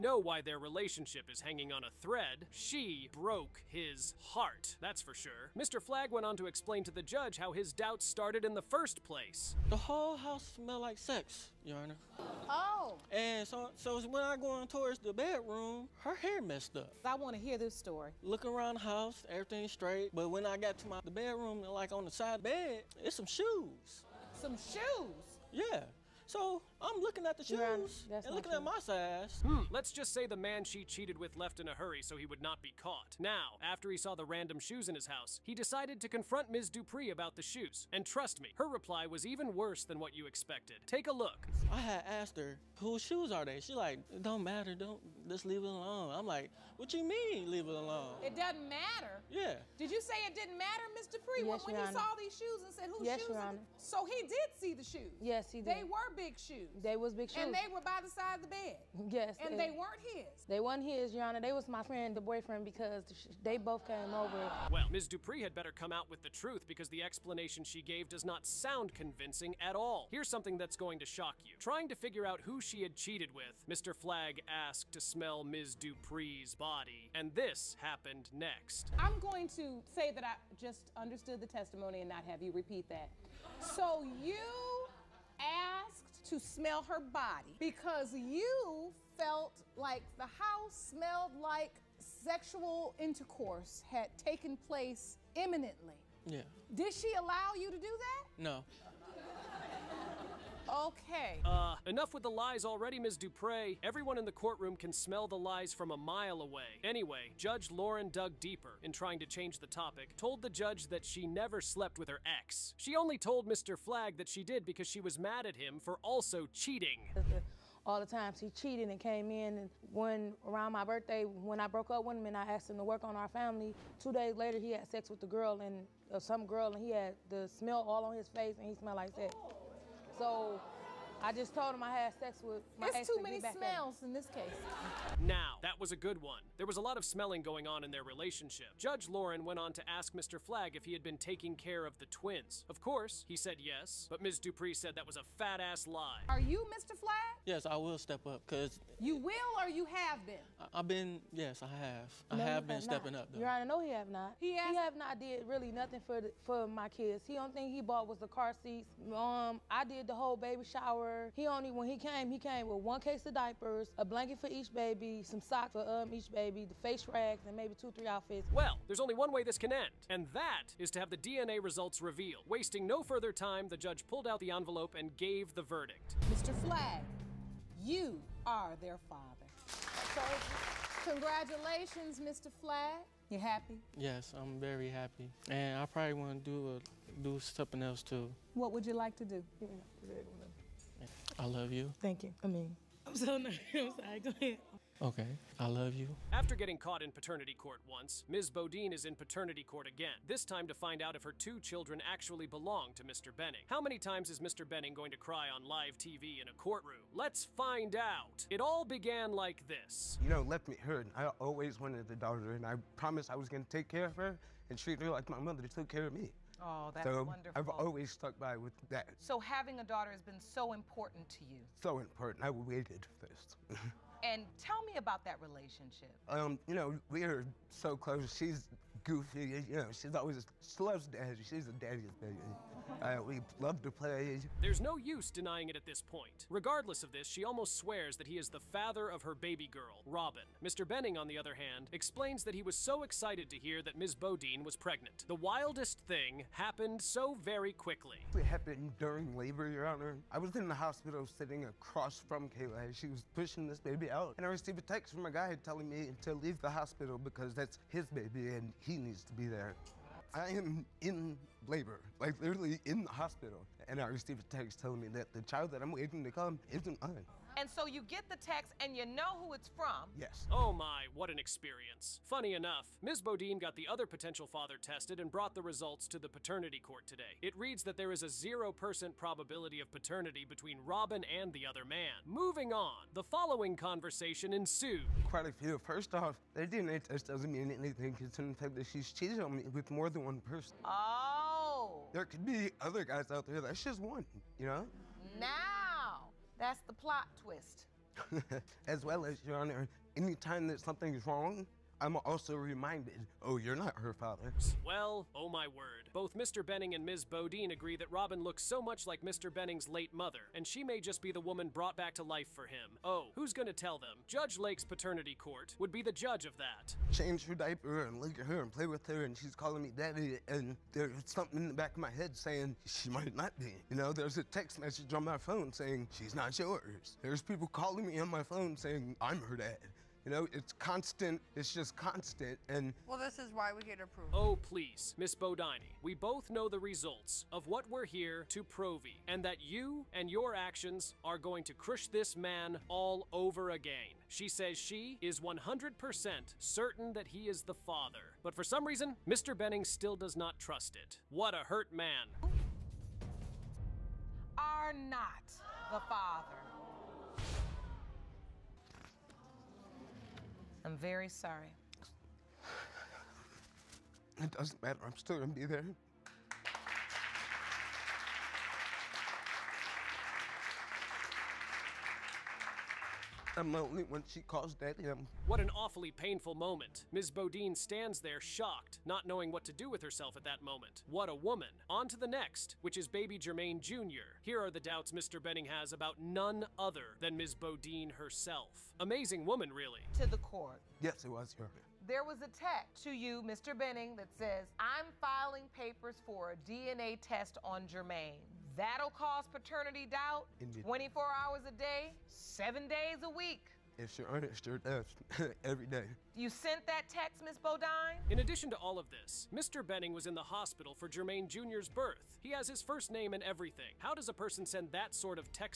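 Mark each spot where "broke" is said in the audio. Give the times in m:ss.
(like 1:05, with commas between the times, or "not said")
0:03, 2:01.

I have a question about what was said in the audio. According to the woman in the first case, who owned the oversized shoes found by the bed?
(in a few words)
My friend.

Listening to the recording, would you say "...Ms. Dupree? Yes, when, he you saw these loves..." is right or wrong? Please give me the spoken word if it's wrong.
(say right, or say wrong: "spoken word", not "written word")
wrong: "shoes", not "loves".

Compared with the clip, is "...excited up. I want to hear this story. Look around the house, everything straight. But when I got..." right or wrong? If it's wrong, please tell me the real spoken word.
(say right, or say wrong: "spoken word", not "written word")
wrong: "messed", not "excited".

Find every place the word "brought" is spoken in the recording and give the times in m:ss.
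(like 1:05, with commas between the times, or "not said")
4:35, 5:11.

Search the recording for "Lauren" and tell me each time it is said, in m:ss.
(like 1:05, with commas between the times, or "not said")
1:47, 2:19.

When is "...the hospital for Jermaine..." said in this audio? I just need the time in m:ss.
6:50.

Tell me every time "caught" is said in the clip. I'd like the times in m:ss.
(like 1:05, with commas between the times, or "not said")
0:32, 3:16.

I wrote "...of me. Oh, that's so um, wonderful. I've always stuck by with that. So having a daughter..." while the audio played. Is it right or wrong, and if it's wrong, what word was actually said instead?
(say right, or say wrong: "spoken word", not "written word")
right.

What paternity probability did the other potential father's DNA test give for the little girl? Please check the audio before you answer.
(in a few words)
0%.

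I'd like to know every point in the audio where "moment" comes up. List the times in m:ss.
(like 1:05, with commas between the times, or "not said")
6:16, 6:20.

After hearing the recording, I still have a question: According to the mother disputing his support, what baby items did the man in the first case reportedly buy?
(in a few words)
Car seats.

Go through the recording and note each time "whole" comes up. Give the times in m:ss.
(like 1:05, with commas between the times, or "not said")
0:09, 2:40.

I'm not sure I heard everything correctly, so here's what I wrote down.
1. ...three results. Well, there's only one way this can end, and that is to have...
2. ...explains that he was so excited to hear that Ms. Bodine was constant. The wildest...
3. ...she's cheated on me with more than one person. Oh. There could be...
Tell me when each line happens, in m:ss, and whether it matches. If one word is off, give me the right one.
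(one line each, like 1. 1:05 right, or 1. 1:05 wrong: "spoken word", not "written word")
1. 2:47 wrong: "outfits", not "results"
2. 4:01 wrong: "pregnant", not "constant"
3. 4:48 right.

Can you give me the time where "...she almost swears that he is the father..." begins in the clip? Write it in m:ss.
3:57.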